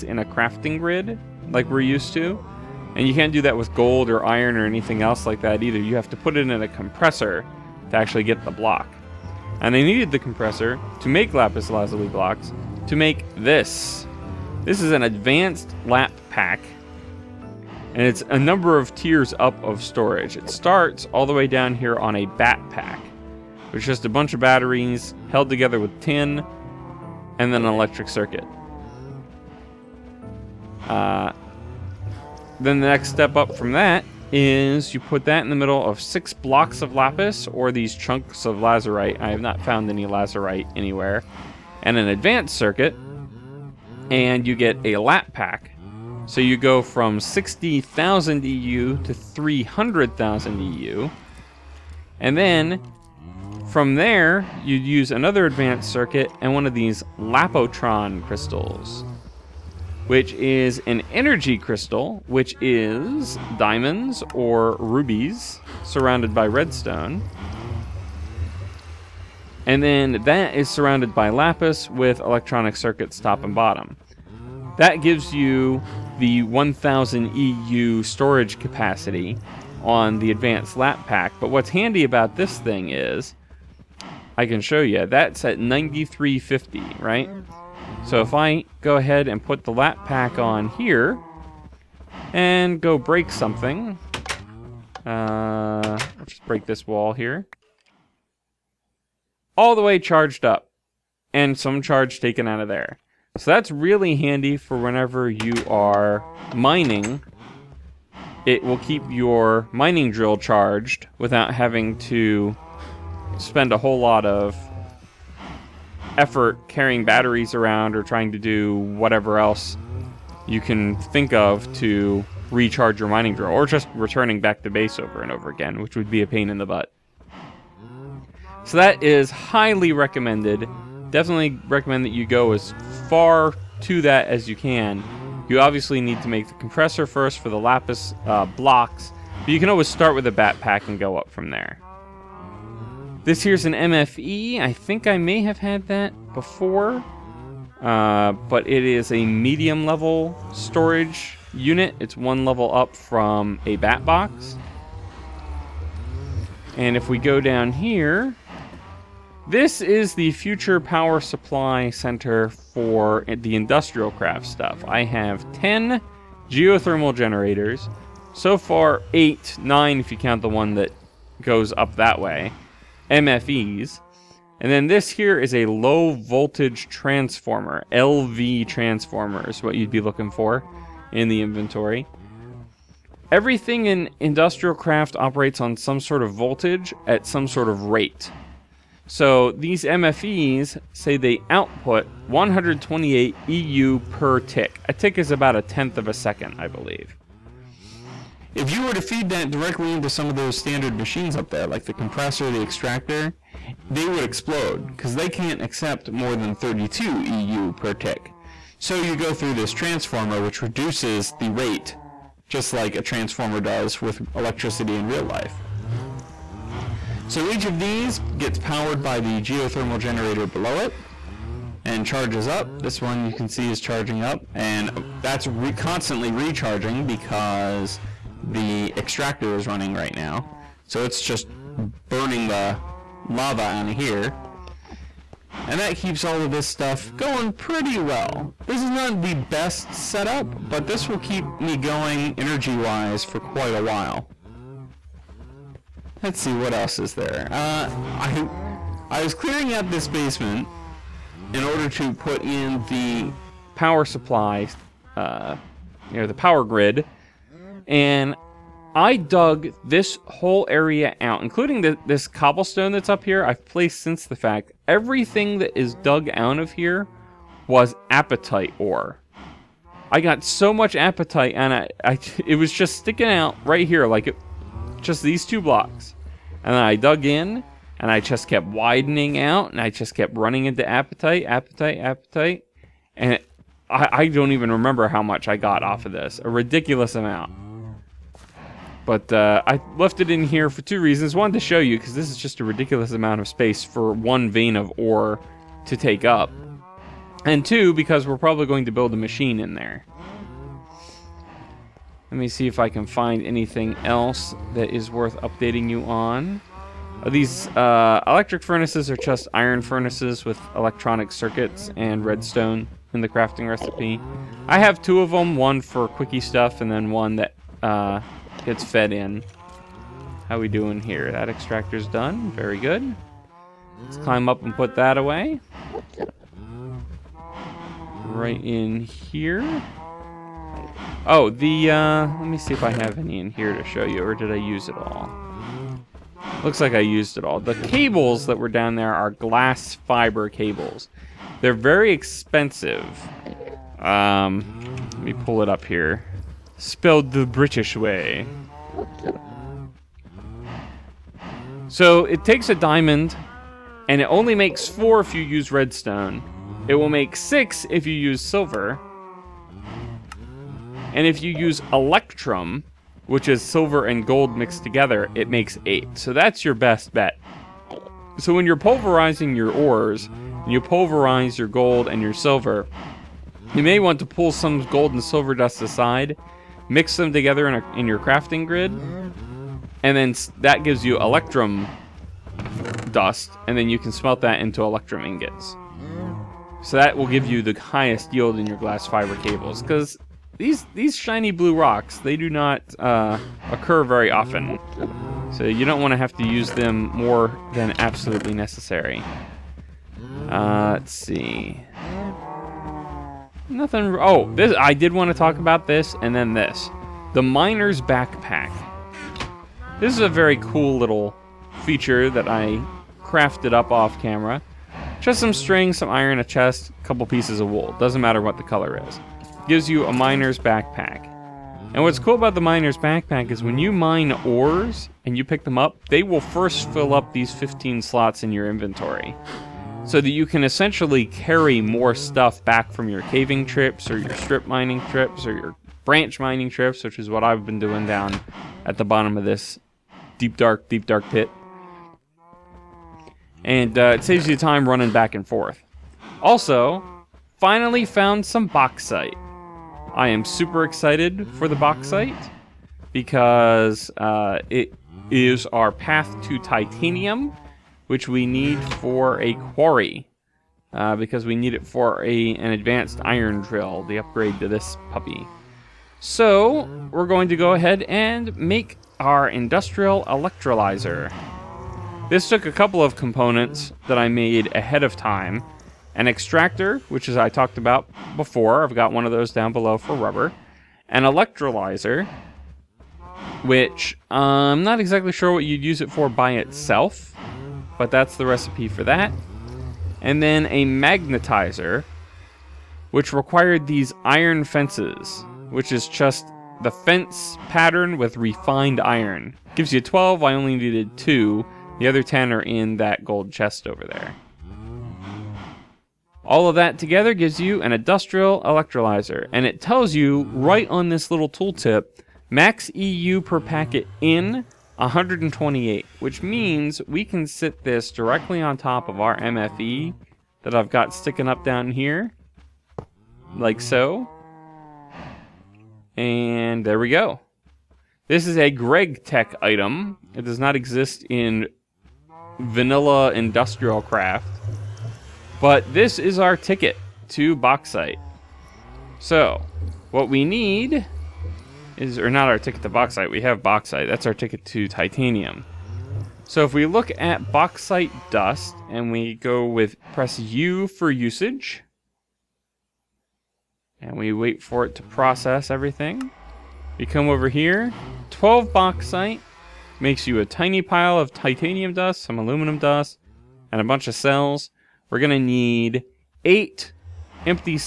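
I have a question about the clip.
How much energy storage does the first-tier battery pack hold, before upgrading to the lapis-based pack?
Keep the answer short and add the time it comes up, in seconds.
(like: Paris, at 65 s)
60,000 EU, at 47 s.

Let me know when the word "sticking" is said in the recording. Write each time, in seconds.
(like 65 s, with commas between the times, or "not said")
272 s, 521 s.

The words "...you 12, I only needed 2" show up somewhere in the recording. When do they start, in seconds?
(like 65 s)
499 s.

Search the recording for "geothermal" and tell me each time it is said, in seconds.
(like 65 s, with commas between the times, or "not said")
166 s, 219 s.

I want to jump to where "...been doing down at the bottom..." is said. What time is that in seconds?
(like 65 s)
437 s.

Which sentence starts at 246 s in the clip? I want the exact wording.
Let's see, what else is there?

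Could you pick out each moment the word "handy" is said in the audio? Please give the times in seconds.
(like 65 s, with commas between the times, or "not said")
81 s, 104 s.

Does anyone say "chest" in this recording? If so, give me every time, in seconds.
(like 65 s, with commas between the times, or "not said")
416 s, 503 s.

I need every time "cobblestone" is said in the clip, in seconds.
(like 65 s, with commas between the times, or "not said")
262 s.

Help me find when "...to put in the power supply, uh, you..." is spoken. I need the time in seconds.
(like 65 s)
251 s.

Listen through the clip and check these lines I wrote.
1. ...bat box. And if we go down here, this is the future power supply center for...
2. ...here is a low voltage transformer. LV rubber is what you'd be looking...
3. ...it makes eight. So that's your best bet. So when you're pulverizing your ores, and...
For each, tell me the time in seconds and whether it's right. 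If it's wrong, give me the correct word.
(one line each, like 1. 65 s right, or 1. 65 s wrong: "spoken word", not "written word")
1. 153 s right
2. 175 s wrong: "transformer", not "rubber"
3. 365 s right.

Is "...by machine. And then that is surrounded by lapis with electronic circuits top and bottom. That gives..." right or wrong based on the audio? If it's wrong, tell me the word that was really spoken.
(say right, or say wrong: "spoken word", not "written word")
wrong: "redstone", not "machine".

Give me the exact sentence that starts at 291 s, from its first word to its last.
One, to show you, because this is just a ridiculous amount of space for one vein of ore to take up.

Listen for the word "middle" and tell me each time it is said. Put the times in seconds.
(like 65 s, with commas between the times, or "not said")
35 s.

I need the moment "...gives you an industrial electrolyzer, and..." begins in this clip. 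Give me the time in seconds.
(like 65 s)
507 s.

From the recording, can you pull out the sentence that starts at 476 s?
An extractor, which as I talked about before.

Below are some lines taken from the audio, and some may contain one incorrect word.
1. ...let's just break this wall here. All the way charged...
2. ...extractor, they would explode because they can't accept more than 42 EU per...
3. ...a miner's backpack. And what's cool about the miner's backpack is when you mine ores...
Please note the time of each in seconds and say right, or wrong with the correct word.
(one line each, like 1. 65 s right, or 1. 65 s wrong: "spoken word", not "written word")
1. 96 s right
2. 202 s wrong: "32", not "42"
3. 420 s right.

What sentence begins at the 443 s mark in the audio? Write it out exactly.
And uh, it saves you time running back and forth.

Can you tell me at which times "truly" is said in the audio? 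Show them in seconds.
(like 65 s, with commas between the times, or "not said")
not said.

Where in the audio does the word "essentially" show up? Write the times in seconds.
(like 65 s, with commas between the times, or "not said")
430 s.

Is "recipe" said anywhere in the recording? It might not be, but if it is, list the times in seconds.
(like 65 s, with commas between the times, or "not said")
313 s, 488 s.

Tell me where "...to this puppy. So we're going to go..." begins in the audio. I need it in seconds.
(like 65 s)
464 s.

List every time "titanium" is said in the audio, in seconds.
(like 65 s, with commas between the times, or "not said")
456 s, 544 s, 561 s.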